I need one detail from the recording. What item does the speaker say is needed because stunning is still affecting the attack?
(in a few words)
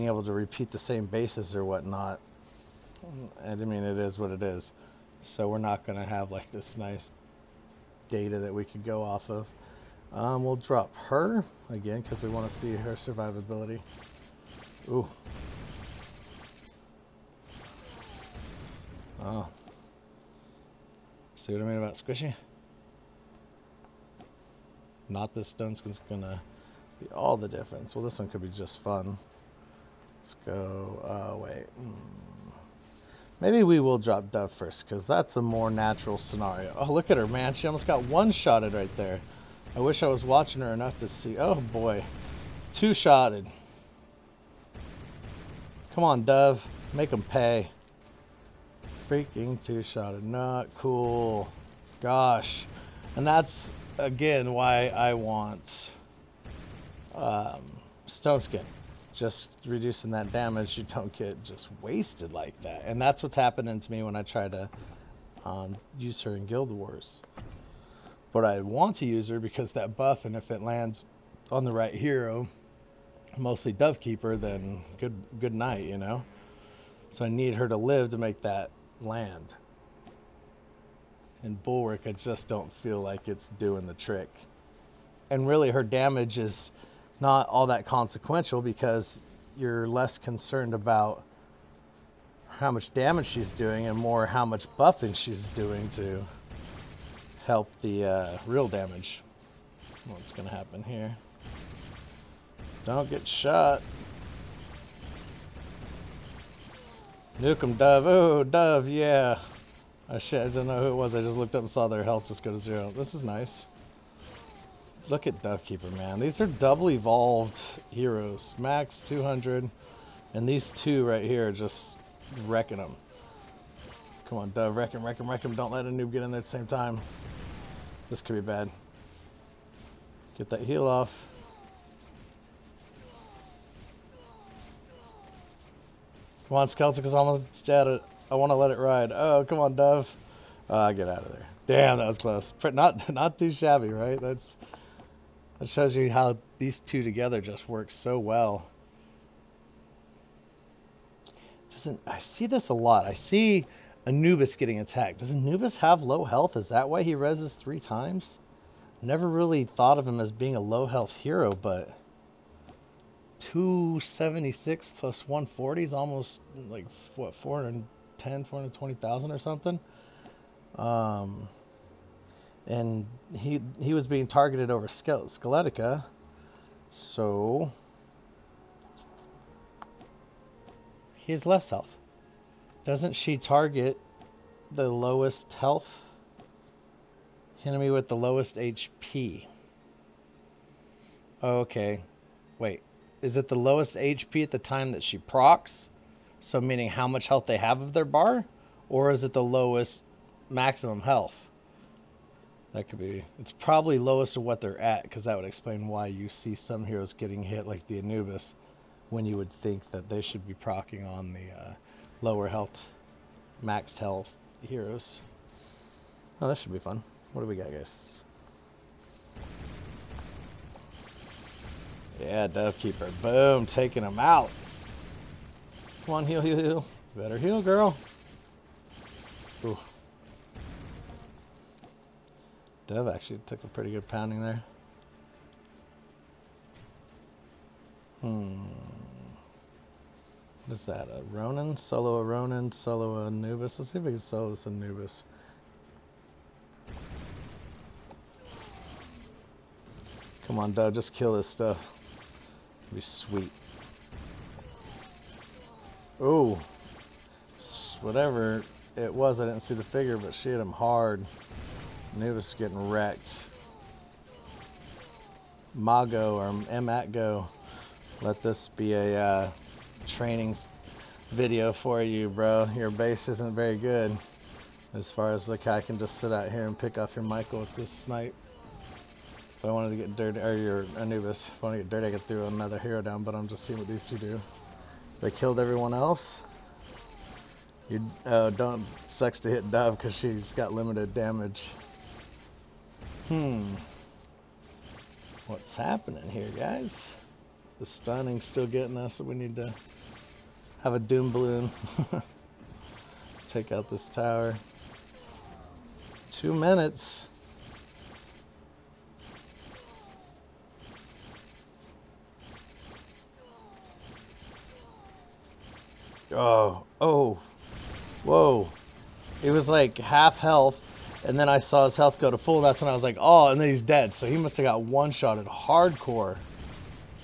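doom balloon.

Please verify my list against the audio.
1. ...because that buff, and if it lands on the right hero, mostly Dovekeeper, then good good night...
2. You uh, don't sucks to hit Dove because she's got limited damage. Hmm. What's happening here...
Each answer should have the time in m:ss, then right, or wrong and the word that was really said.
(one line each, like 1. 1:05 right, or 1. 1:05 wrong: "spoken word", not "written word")
1. 1:09 right
2. 4:47 right.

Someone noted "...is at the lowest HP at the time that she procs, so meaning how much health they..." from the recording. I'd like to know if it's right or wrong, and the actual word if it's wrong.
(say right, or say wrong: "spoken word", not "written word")
right.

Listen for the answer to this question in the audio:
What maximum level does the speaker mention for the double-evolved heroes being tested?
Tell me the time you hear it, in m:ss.
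1:58.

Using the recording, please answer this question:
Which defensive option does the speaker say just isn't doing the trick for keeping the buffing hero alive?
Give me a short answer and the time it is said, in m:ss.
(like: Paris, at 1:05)
Bulwark, at 1:21.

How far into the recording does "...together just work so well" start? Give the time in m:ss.
2:27.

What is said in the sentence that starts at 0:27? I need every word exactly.
Well, this one could be just fun.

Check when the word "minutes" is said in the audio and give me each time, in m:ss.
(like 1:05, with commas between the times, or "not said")
5:06.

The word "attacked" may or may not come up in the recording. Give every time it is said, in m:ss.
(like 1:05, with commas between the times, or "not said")
2:34.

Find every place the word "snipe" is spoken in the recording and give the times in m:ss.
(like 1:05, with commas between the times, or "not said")
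4:37.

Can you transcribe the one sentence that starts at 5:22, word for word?
That's when I was like, oh, and then he's dead.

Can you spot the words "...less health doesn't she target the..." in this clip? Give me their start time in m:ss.
3:01.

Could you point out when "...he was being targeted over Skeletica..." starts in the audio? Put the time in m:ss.
2:53.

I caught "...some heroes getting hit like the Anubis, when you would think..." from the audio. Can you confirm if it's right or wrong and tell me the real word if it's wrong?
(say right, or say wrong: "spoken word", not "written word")
right.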